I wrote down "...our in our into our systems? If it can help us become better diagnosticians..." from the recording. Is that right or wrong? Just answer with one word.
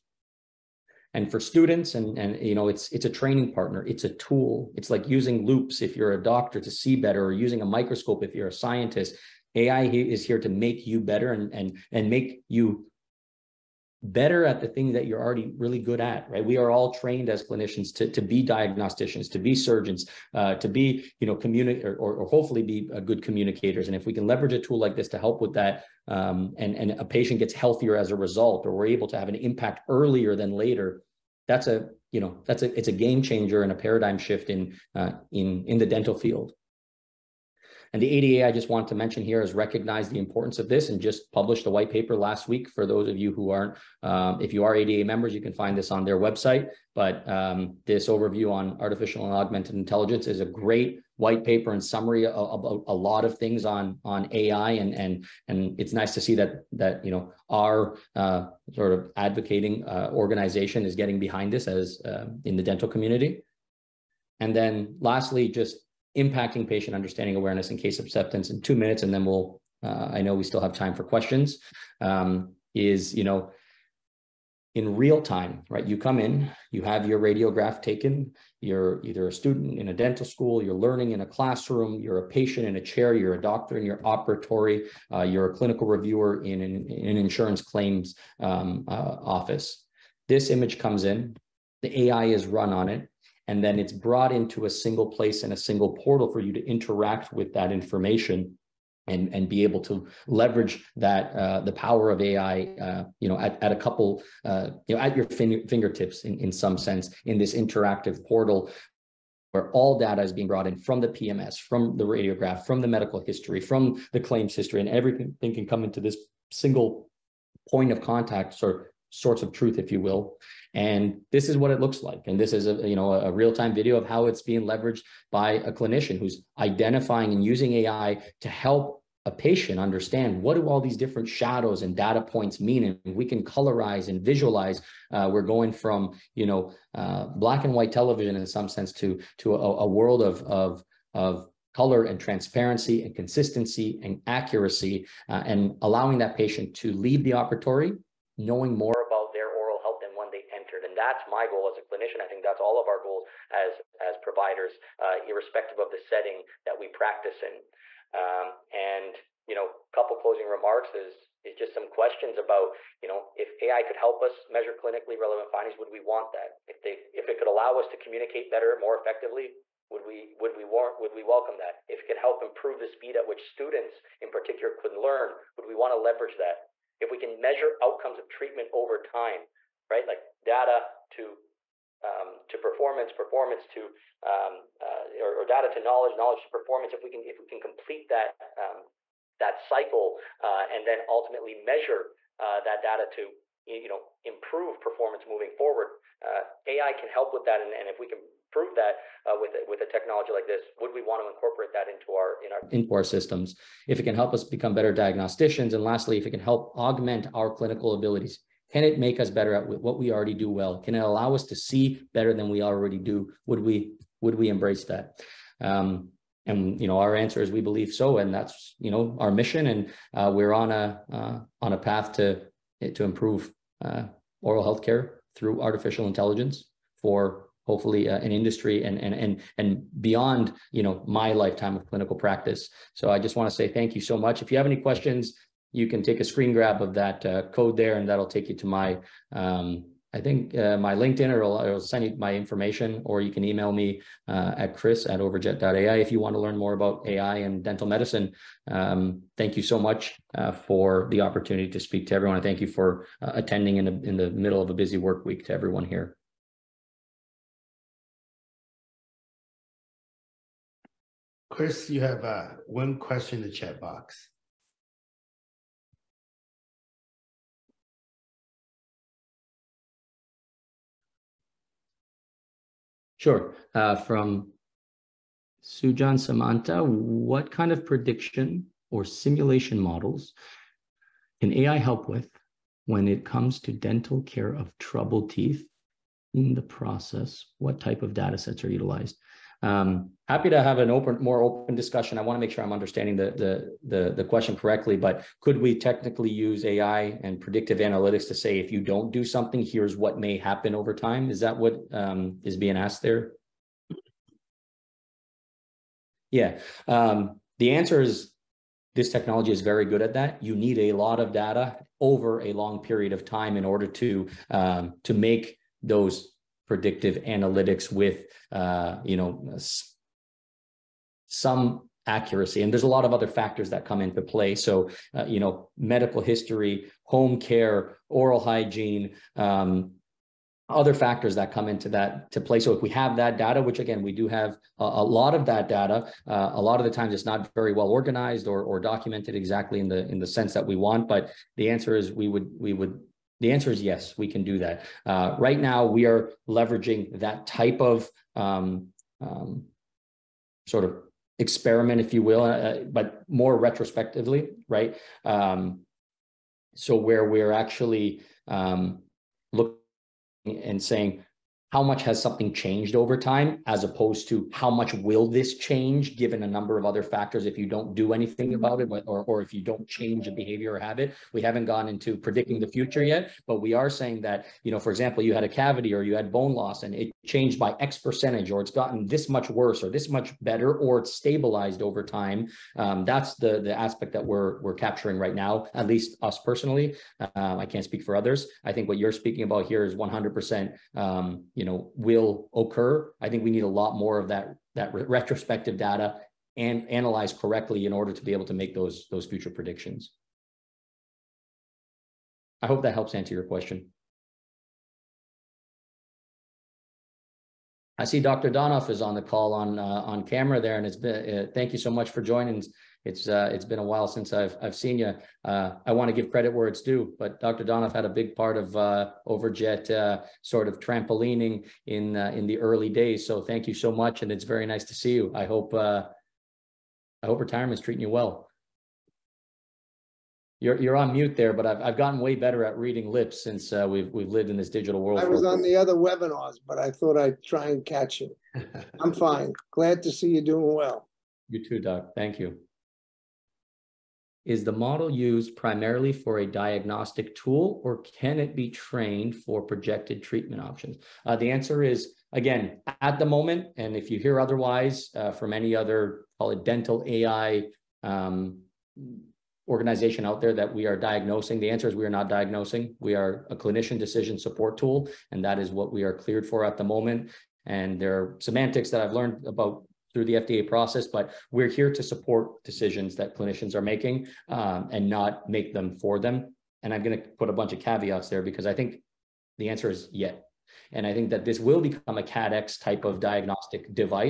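right.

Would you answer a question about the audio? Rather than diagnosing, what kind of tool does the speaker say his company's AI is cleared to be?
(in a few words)
clinician decision support tool.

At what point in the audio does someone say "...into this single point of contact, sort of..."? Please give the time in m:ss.
1:55.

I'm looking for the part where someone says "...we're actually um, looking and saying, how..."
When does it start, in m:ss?
5:57.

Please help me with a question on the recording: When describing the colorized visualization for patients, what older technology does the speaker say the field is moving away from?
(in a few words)
black and white television.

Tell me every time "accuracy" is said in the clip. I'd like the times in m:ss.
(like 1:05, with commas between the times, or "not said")
2:24, 5:22.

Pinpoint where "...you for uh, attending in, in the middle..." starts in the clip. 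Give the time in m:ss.
4:12.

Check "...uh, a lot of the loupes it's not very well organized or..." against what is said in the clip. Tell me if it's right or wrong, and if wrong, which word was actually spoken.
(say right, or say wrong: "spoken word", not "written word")
wrong: "times", not "loupes".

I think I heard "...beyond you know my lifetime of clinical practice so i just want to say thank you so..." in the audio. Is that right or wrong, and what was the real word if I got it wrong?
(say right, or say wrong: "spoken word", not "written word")
right.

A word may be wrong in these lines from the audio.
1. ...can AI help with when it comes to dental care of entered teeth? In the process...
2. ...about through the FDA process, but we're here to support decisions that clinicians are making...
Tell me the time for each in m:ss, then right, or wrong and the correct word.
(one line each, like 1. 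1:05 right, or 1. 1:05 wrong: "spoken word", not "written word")
1. 4:41 wrong: "troubled", not "entered"
2. 7:49 right.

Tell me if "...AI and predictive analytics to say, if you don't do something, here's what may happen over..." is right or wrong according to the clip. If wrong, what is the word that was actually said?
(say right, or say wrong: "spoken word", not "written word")
right.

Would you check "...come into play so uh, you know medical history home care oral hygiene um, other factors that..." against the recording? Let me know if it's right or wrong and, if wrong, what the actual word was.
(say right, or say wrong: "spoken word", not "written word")
right.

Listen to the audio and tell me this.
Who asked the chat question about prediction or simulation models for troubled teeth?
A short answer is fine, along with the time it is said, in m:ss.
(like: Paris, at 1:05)
Sujan Samanta, at 4:35.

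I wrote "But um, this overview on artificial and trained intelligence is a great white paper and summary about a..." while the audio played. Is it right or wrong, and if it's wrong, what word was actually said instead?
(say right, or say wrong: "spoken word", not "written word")
wrong: "augmented", not "trained".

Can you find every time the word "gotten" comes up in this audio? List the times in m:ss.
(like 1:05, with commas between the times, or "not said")
6:18, 7:11.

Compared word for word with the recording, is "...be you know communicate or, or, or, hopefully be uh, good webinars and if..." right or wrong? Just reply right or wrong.
wrong.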